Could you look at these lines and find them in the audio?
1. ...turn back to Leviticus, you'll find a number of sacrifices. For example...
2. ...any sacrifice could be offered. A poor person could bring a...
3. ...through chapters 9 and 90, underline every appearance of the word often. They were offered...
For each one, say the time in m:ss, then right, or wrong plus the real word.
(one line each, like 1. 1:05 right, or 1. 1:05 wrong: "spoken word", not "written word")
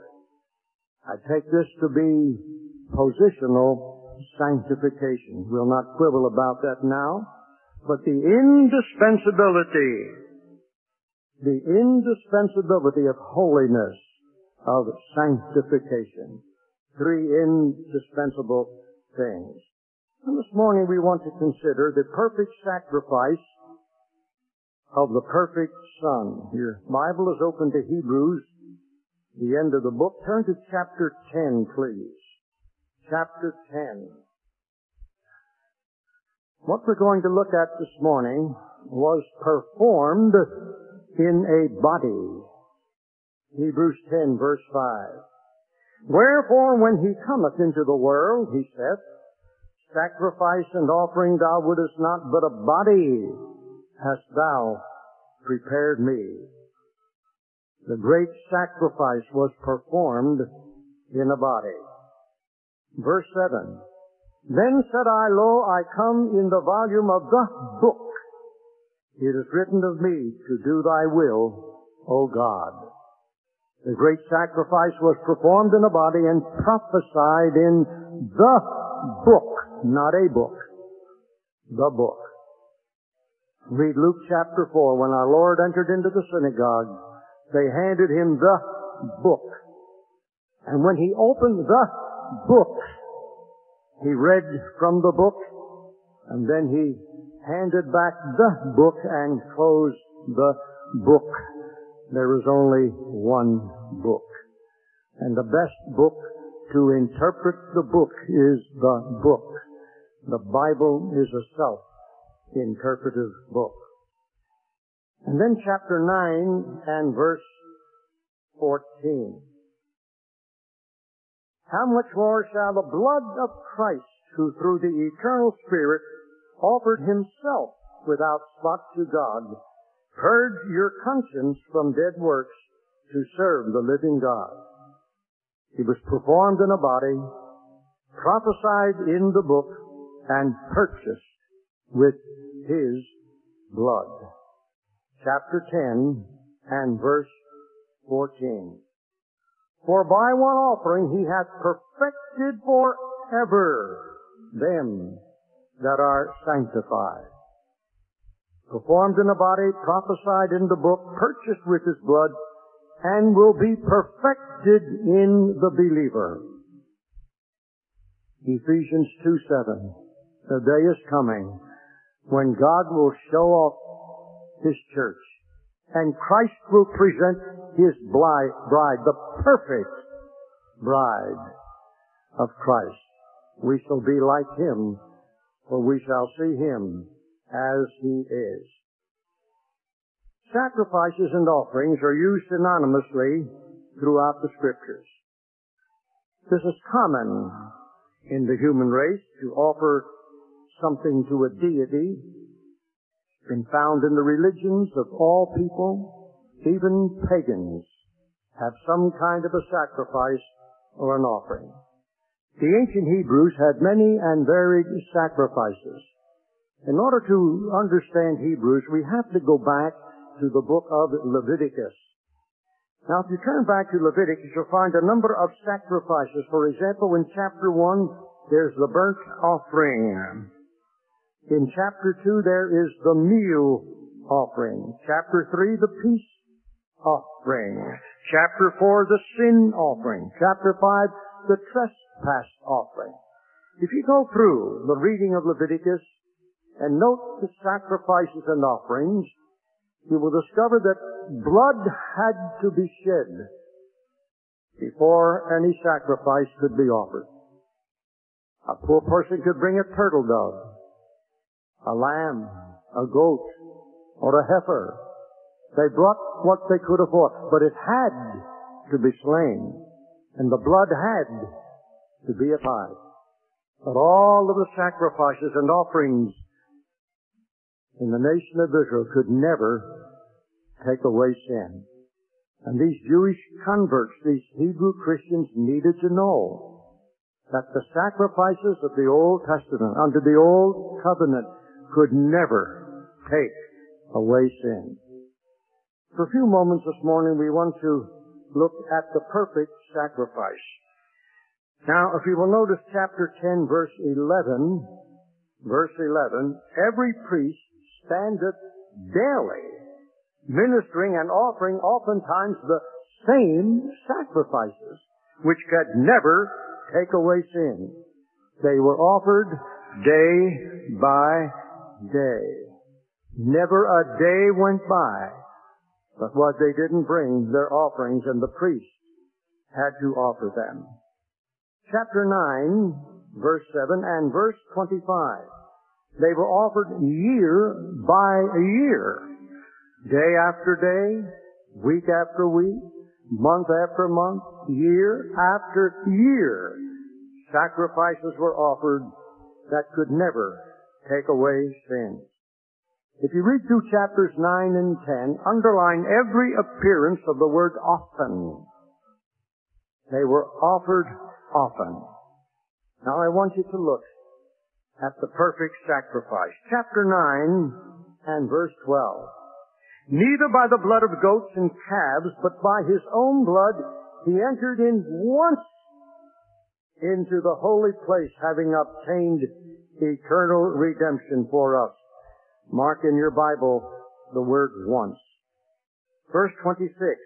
1. 3:43 right
2. 4:15 right
3. 5:53 wrong: "10", not "90".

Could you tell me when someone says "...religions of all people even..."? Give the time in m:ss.
3:24.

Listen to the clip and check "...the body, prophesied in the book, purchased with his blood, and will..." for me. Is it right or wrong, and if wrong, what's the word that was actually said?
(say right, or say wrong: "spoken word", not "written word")
right.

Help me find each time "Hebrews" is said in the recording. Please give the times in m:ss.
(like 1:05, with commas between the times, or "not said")
0:27, 0:43, 3:33, 3:38, 4:44.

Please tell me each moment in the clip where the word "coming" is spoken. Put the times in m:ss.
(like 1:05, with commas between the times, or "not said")
2:51.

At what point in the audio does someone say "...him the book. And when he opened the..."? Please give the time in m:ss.
1:28.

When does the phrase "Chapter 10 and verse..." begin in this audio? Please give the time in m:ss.
2:25.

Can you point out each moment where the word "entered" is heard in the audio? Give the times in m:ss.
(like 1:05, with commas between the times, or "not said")
1:25, 6:14.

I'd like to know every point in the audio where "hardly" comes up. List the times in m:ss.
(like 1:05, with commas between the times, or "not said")
not said.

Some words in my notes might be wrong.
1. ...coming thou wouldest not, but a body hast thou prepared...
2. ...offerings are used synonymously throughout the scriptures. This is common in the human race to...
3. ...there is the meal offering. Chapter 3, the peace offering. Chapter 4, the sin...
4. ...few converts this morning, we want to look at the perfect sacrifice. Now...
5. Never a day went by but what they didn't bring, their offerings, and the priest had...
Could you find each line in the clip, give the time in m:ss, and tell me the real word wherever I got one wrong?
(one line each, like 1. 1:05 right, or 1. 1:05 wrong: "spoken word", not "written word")
1. 0:50 wrong: "offering", not "coming"
2. 3:11 right
3. 3:52 right
4. 4:56 wrong: "moments", not "converts"
5. 5:23 right.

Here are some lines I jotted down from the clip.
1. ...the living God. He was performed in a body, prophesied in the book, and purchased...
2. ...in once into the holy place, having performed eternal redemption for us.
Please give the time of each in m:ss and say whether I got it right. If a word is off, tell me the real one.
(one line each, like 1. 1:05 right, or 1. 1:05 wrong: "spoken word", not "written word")
1. 2:13 right
2. 6:14 wrong: "obtained", not "performed".